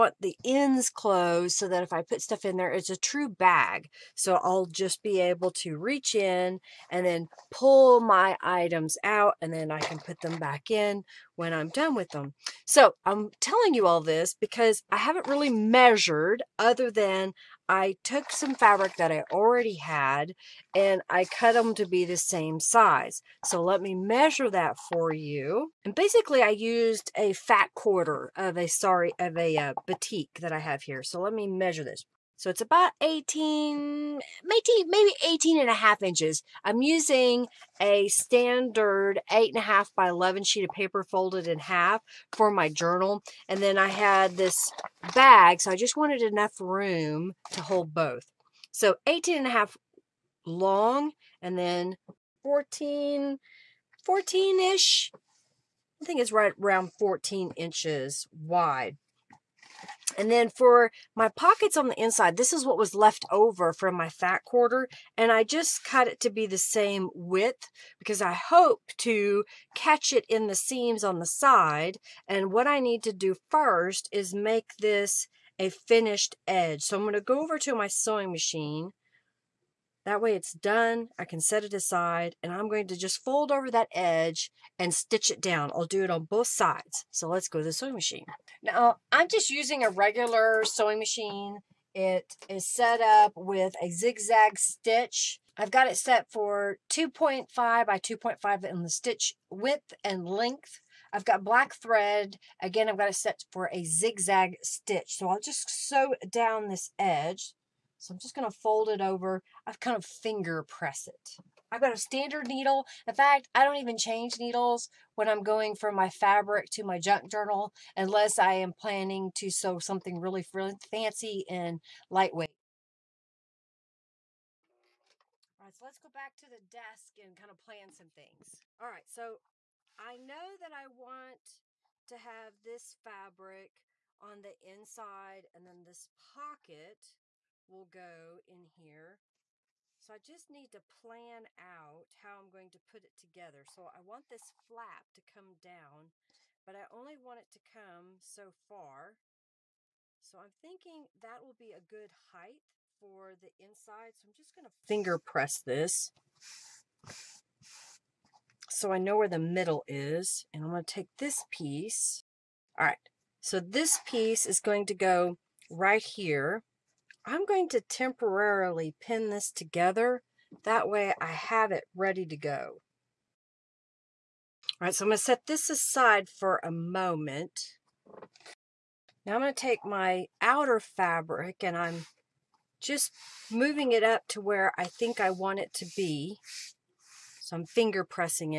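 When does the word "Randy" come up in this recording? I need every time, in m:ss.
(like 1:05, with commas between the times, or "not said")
not said.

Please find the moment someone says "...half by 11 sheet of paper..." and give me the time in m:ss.
0:39.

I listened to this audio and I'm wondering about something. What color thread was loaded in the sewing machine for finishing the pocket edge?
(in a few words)
black.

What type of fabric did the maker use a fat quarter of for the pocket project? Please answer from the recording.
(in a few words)
batik.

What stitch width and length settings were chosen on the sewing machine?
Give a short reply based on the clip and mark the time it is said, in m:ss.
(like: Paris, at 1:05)
2.5 by 2.5, at 1:36.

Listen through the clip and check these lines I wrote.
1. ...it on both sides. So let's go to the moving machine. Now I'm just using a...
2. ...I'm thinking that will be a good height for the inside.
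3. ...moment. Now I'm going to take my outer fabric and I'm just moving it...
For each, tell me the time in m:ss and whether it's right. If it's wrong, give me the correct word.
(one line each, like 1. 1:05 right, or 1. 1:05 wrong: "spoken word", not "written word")
1. 1:26 wrong: "sewing", not "moving"
2. 2:30 right
3. 2:56 right.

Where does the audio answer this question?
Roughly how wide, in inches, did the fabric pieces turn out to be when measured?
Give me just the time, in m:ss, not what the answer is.
0:56.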